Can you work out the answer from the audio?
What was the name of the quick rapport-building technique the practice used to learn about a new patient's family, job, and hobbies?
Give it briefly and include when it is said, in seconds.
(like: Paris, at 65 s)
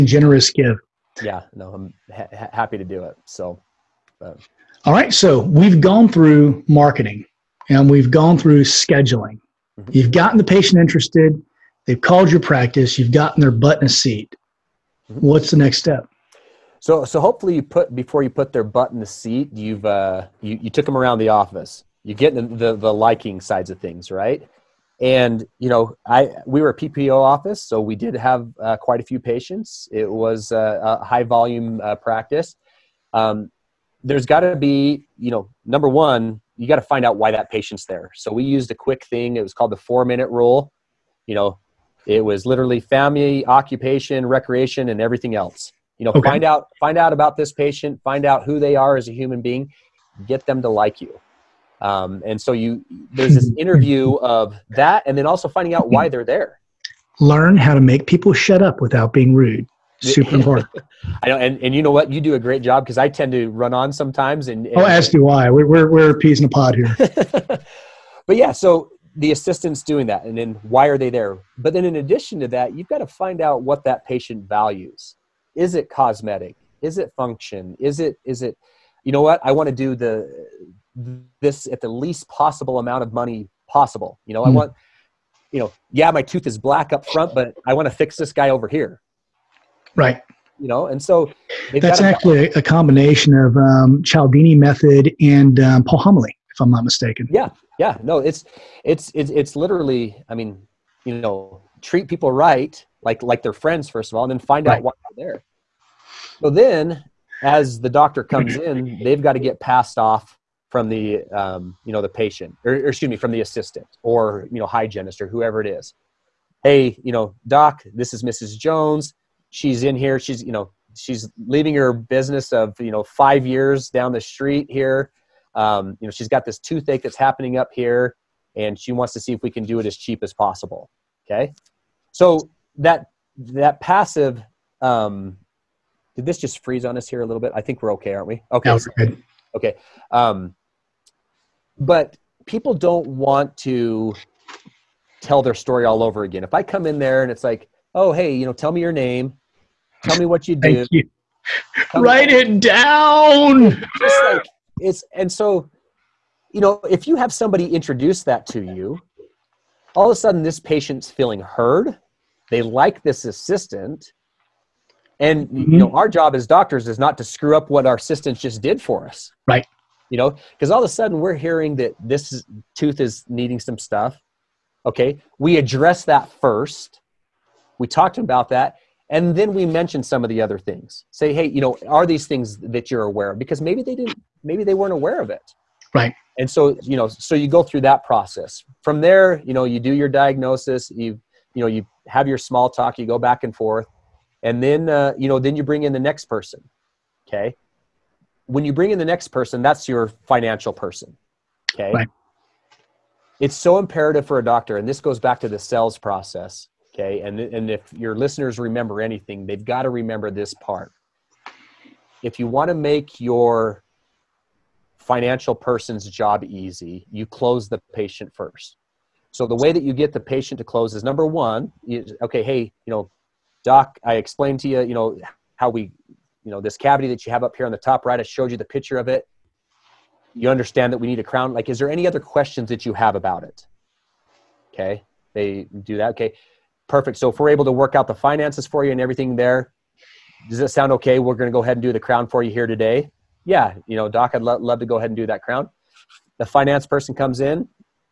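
four minute rule, at 39 s.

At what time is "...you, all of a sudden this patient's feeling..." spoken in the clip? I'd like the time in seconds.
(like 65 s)
158 s.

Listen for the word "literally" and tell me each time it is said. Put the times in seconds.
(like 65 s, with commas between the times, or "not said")
42 s, 99 s.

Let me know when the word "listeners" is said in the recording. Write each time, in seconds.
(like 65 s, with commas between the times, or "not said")
208 s.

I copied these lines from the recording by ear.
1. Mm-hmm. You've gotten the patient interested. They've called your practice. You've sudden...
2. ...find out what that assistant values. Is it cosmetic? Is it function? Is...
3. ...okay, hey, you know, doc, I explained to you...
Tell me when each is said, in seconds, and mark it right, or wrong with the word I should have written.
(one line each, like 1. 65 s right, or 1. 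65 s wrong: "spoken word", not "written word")
1. 9 s wrong: "gotten", not "sudden"
2. 73 s wrong: "patient", not "assistant"
3. 222 s right.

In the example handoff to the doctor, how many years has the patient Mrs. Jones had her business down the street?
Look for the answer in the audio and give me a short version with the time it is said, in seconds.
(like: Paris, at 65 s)
5, at 123 s.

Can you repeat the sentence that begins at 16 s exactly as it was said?
So, so hopefully you put before you put their butt in the seat, you've uh, you, you took them around the office.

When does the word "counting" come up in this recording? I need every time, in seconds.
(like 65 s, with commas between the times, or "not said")
not said.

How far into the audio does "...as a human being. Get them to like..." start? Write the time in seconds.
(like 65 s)
48 s.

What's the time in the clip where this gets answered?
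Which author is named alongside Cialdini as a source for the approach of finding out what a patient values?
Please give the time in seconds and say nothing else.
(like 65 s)
95 s.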